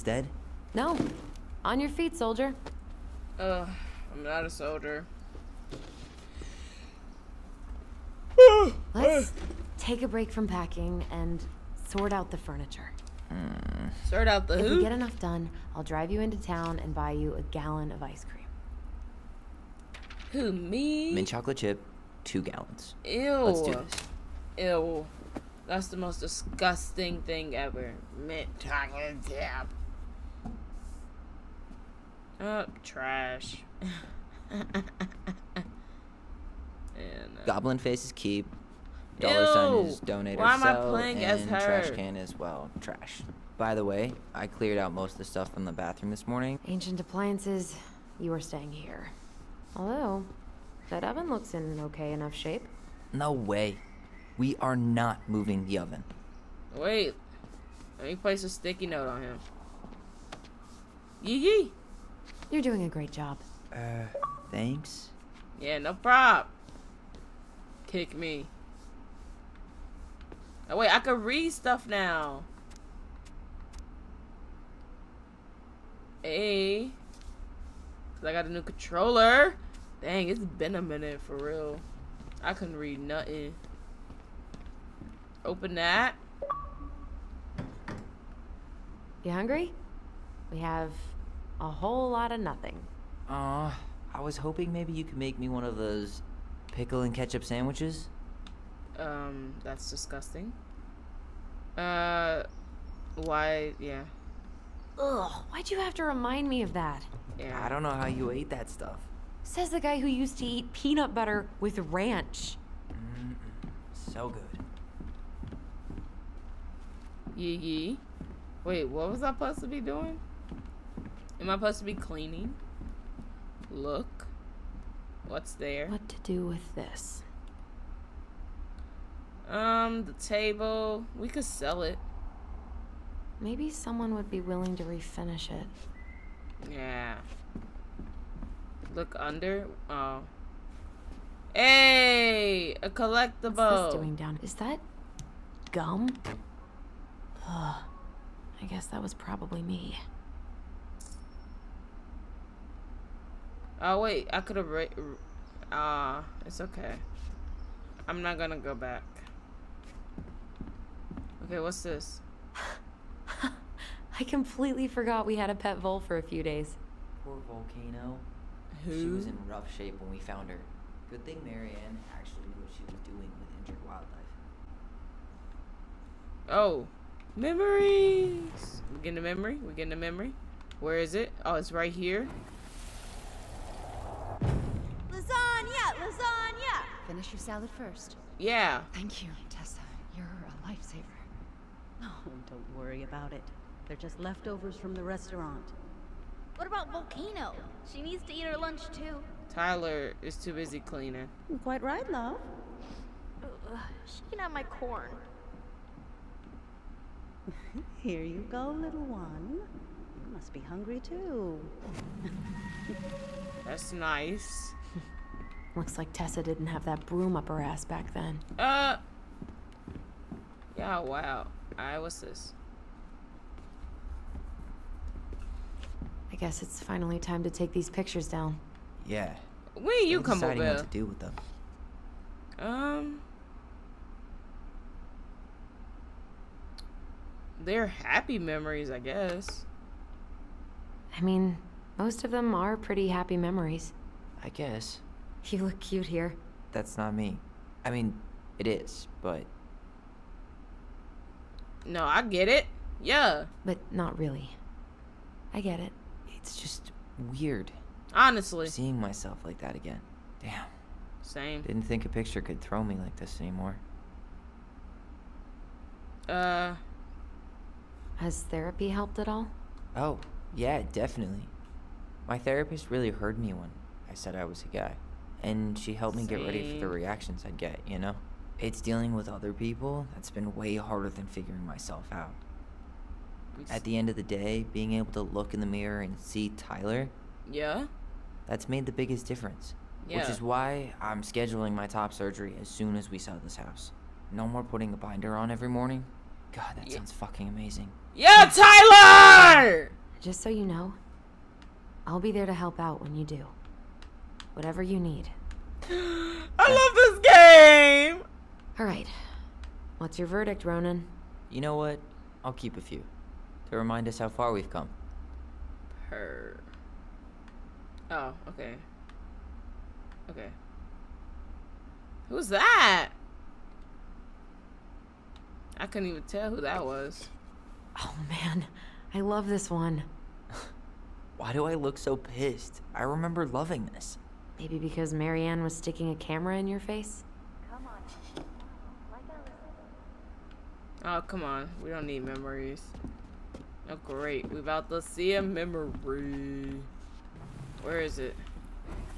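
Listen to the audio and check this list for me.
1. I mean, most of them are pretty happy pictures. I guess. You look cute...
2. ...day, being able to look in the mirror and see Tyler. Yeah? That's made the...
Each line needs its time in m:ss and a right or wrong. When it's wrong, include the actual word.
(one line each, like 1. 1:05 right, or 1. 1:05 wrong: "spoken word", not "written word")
1. 4:01 wrong: "memories", not "pictures"
2. 4:44 right.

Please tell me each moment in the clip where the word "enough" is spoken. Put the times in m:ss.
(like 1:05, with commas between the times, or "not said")
0:14, 0:52.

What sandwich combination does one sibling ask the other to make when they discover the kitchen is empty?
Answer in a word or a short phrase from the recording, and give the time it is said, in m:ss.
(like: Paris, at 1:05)
Pickle and ketchup, at 1:36.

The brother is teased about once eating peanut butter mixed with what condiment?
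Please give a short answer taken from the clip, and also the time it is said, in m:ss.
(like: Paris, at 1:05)
Ranch, at 1:51.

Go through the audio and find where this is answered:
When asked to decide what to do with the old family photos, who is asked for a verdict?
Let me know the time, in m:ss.
5:10.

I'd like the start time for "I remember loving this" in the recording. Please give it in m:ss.
5:32.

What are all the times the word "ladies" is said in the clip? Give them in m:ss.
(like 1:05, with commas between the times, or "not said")
not said.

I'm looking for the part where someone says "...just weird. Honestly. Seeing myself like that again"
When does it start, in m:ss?
4:16.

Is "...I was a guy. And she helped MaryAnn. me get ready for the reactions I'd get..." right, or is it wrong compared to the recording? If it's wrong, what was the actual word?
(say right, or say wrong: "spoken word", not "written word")
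wrong: "Same", not "MaryAnn".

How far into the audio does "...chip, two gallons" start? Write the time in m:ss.
0:21.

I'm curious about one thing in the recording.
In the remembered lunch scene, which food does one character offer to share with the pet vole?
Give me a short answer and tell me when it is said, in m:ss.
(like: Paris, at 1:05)
Corn, at 3:24.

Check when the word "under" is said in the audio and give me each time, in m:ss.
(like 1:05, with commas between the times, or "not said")
2:19.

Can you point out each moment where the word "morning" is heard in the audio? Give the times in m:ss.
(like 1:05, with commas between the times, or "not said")
0:46, 4:55.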